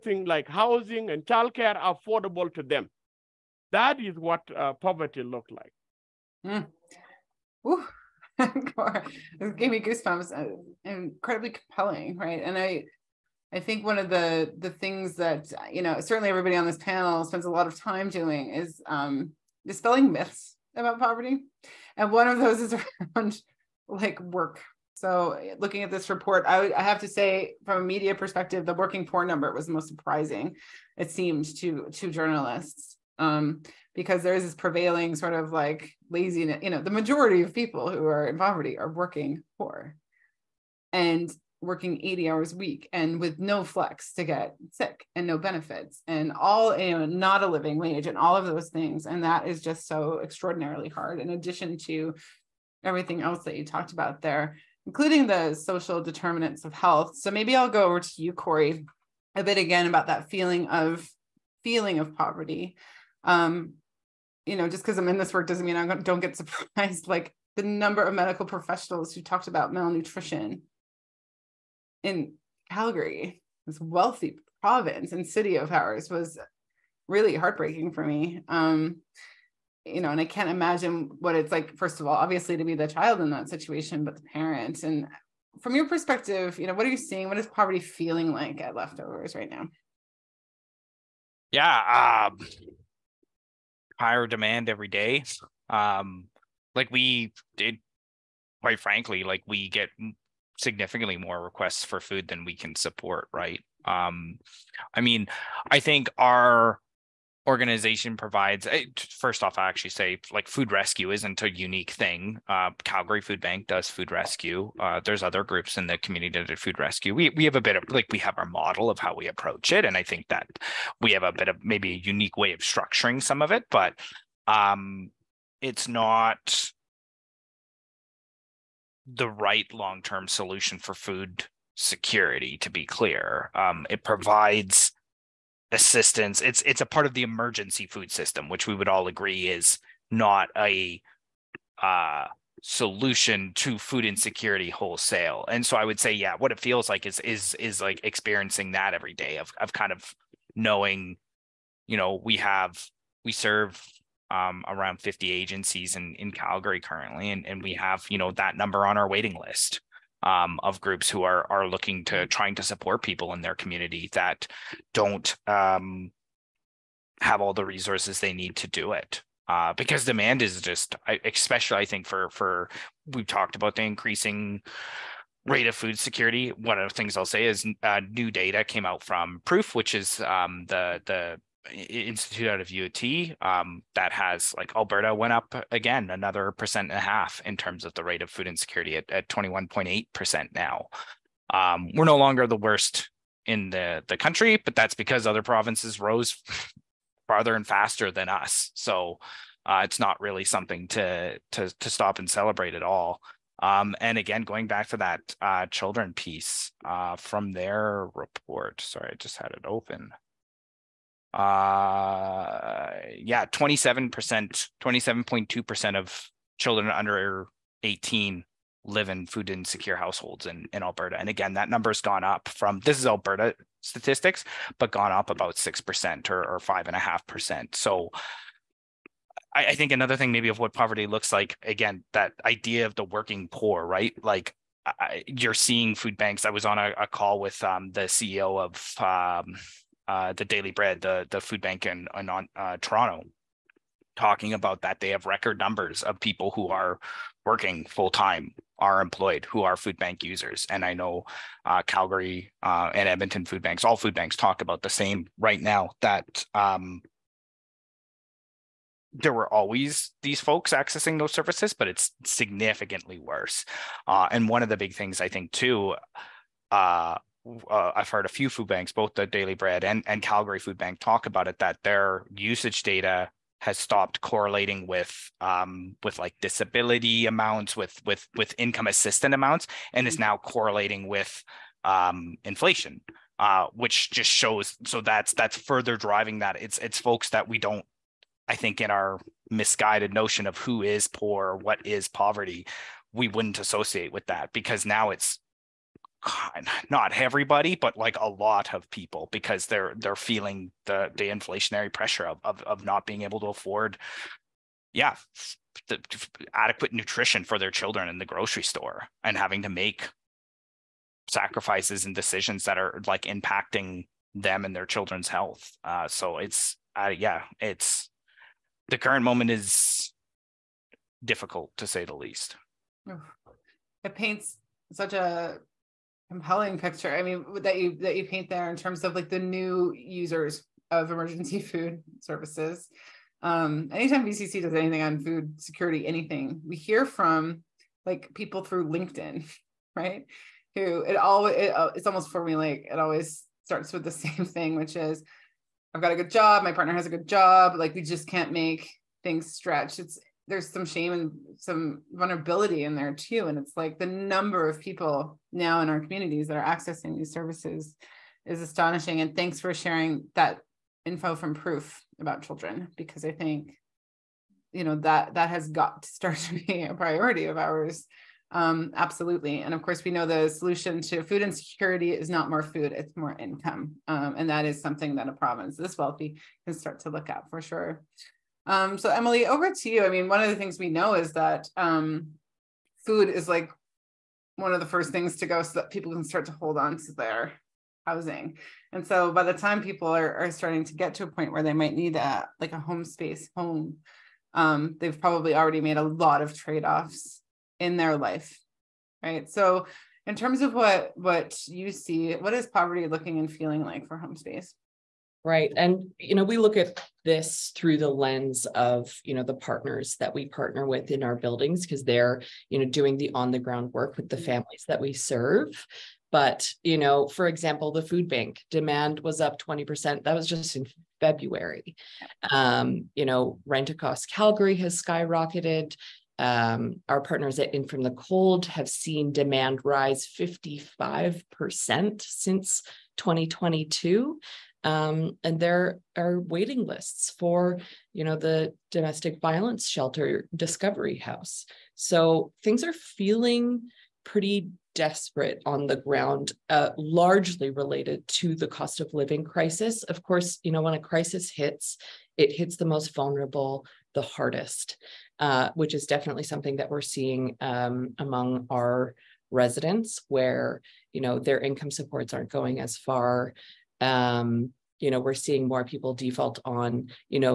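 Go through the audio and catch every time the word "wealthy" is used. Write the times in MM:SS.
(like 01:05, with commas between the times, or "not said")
01:13, 06:15.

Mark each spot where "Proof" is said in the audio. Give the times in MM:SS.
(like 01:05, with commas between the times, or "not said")
02:59, 06:01.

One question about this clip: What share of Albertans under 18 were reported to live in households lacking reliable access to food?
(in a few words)
27.2%.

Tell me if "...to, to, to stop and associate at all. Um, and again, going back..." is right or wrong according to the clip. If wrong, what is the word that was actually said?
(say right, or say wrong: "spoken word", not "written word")
wrong: "celebrate", not "associate".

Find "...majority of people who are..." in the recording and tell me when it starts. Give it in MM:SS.
00:36.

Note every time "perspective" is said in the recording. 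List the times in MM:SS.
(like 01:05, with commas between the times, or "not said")
00:28, 01:25.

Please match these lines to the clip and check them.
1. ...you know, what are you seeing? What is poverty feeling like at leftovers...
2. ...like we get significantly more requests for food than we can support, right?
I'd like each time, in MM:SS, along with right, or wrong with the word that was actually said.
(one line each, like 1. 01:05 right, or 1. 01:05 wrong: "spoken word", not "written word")
1. 01:26 right
2. 01:39 right.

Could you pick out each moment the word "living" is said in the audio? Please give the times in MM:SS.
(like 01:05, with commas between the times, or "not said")
00:47, 07:29.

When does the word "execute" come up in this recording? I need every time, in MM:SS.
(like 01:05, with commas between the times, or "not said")
not said.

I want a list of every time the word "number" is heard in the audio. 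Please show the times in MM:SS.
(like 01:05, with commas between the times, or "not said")
00:29, 01:07, 02:38, 03:41, 04:05, 05:54.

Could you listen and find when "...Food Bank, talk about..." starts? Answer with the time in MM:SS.
04:30.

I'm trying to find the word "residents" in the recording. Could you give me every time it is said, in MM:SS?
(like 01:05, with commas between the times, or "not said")
07:39.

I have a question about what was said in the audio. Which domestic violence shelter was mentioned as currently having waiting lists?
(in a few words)
Discovery House.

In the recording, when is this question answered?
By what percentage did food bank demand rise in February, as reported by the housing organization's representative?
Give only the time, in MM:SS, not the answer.
06:59.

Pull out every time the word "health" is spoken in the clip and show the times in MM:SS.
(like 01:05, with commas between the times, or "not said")
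00:56, 05:15.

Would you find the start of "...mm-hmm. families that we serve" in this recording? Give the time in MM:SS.
06:54.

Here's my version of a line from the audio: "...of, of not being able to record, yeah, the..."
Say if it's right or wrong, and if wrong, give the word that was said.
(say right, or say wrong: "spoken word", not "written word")
wrong: "afford", not "record".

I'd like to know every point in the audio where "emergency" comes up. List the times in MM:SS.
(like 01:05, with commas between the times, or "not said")
02:17, 05:31.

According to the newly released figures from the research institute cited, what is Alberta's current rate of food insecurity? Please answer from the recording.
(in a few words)
21.8%.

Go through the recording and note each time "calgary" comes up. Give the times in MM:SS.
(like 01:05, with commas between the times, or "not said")
01:12, 01:52, 02:36, 04:11, 04:30, 07:04.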